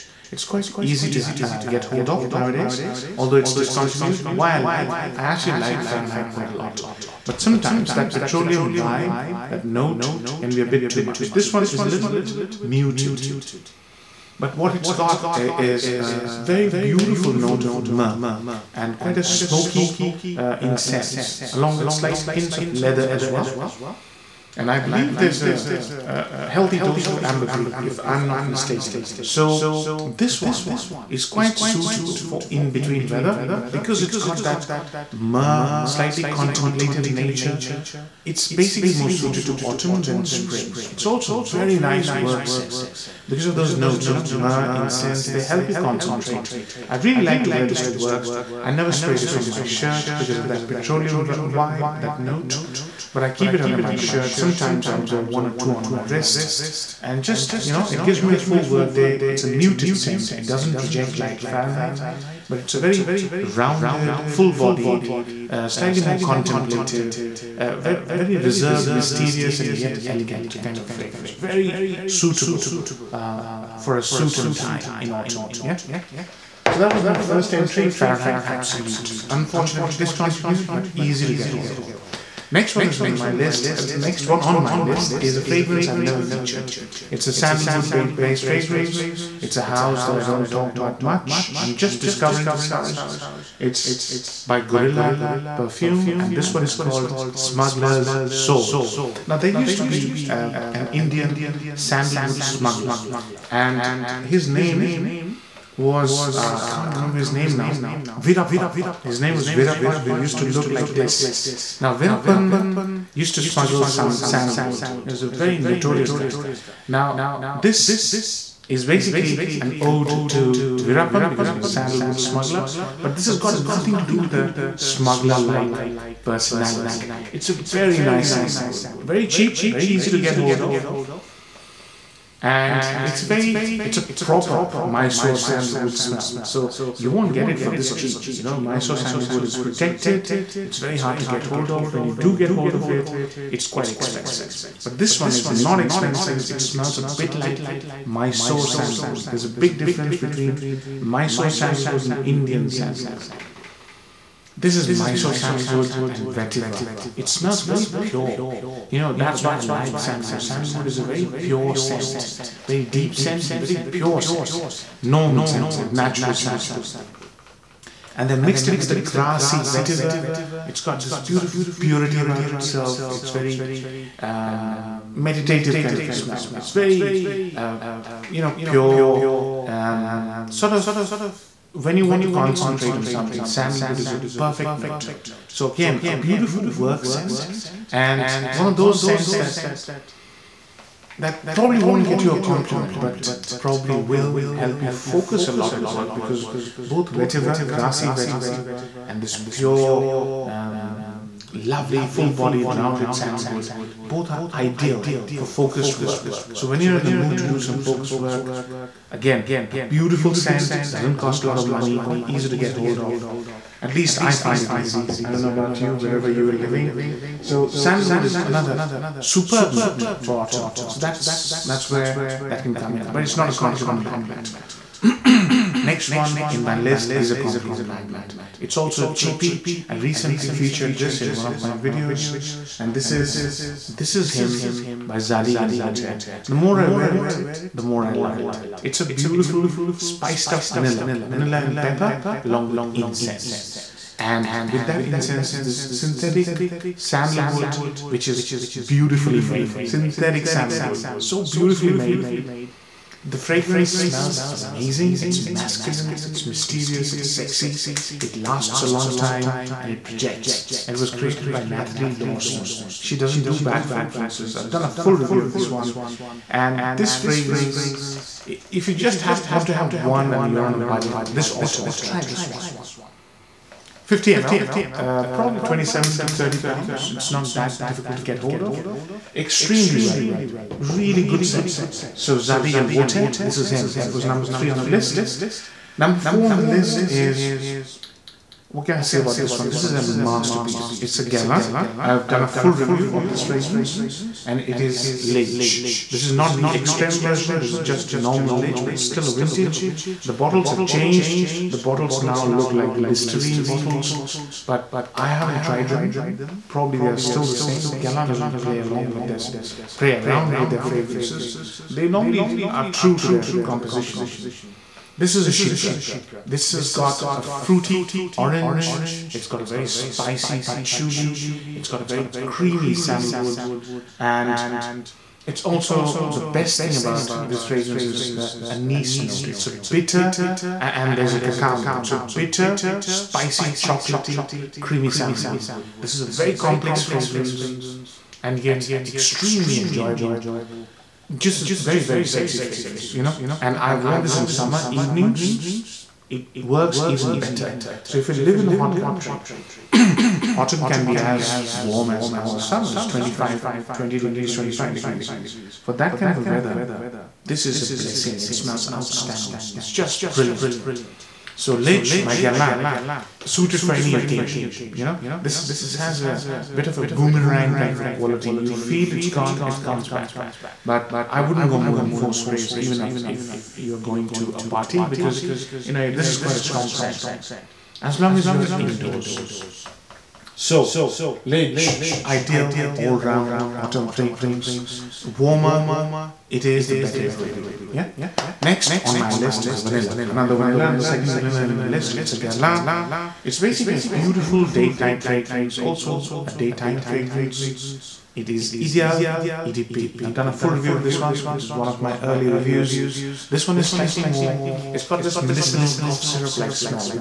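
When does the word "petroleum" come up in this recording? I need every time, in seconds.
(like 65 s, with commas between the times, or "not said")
8 s, 50 s.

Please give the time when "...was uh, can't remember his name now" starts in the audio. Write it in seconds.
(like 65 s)
105 s.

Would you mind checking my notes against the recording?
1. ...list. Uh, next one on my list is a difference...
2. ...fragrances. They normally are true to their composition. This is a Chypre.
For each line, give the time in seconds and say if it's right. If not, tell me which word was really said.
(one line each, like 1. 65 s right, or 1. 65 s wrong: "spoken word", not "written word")
1. 83 s wrong: "fragrance", not "difference"
2. 310 s right.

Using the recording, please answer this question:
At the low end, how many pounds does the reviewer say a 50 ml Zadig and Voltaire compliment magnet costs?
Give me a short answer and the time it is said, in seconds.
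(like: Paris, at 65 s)
27, at 275 s.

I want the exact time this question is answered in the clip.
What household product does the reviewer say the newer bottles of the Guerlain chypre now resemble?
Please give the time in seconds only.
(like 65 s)
303 s.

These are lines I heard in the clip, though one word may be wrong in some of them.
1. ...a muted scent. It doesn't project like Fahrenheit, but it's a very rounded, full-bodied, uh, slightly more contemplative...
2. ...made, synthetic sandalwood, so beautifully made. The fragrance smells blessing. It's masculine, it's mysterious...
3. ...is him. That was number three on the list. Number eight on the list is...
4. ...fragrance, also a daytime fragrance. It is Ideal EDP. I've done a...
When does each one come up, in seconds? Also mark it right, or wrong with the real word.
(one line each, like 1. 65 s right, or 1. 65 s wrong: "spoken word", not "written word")
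1. 59 s right
2. 249 s wrong: "amazing", not "blessing"
3. 283 s wrong: "four", not "eight"
4. 395 s right.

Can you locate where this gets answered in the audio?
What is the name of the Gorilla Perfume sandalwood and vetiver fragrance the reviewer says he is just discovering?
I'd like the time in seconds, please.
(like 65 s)
97 s.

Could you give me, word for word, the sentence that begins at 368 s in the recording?
You feel it's gone, it comes back.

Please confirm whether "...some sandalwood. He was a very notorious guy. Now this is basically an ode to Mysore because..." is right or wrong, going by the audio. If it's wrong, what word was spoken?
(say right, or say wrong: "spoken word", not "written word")
wrong: "Veerappan", not "Mysore".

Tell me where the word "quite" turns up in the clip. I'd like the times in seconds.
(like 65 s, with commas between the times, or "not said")
0 s, 6 s, 18 s, 31 s, 143 s, 211 s, 376 s.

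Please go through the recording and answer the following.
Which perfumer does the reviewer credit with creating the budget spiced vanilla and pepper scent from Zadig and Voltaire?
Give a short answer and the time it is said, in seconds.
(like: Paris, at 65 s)
Nathalie Lorson, at 261 s.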